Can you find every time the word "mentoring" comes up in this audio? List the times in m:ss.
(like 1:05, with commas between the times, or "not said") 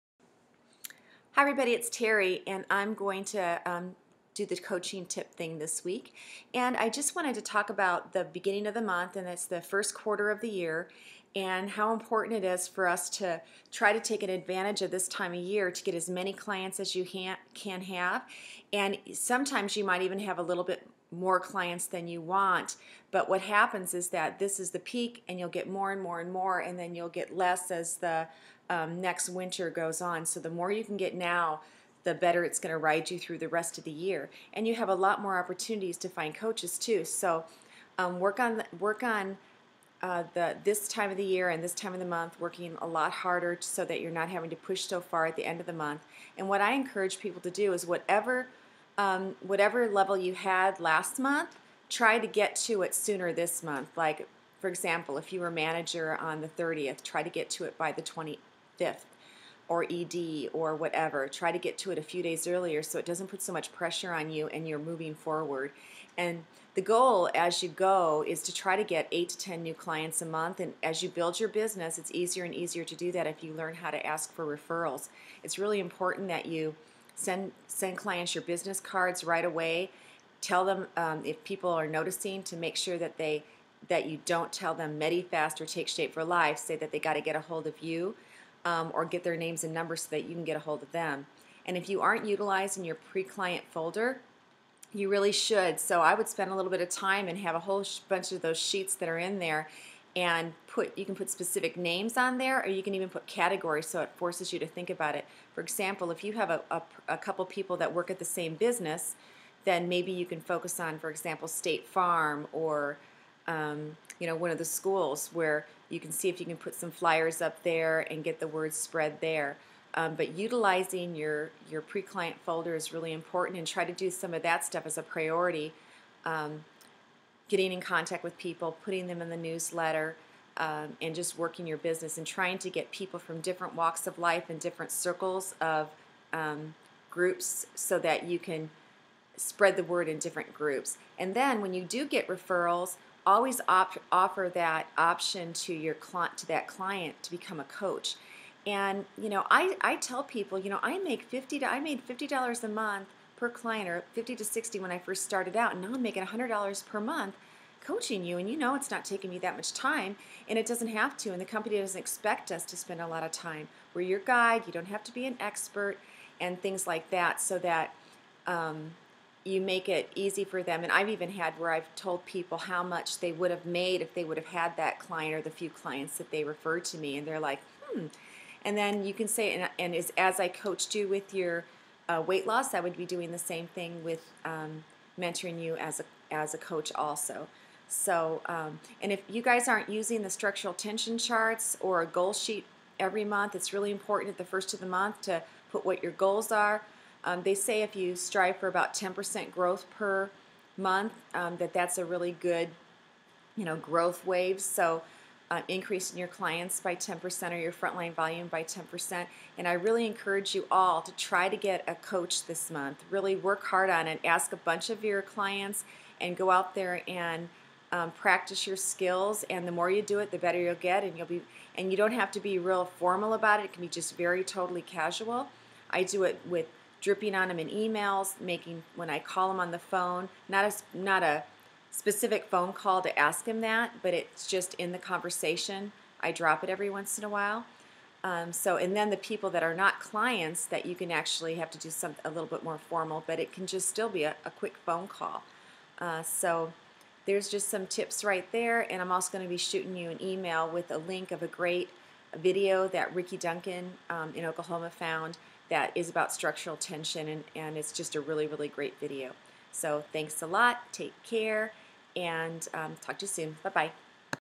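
3:05.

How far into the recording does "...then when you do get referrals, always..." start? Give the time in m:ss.
2:21.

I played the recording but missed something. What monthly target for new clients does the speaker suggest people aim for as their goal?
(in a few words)
8 to 10.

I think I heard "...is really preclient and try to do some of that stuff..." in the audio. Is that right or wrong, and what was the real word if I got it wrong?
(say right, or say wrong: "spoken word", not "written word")
wrong: "important", not "preclient".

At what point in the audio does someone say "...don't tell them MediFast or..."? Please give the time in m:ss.
1:24.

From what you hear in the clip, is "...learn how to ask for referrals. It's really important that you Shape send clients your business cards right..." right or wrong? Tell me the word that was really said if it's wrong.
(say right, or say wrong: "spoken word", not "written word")
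wrong: "Send", not "Shape".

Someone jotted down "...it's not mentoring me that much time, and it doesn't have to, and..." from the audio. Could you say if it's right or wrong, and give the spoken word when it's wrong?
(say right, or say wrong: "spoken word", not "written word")
wrong: "taking", not "mentoring".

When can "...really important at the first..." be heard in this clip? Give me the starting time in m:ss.
3:13.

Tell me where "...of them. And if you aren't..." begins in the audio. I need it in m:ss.
1:30.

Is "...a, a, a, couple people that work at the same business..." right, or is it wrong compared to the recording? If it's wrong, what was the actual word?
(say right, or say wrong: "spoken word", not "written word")
right.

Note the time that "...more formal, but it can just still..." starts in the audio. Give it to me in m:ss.
4:02.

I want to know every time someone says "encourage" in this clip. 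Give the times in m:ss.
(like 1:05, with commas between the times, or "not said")
0:46, 3:30.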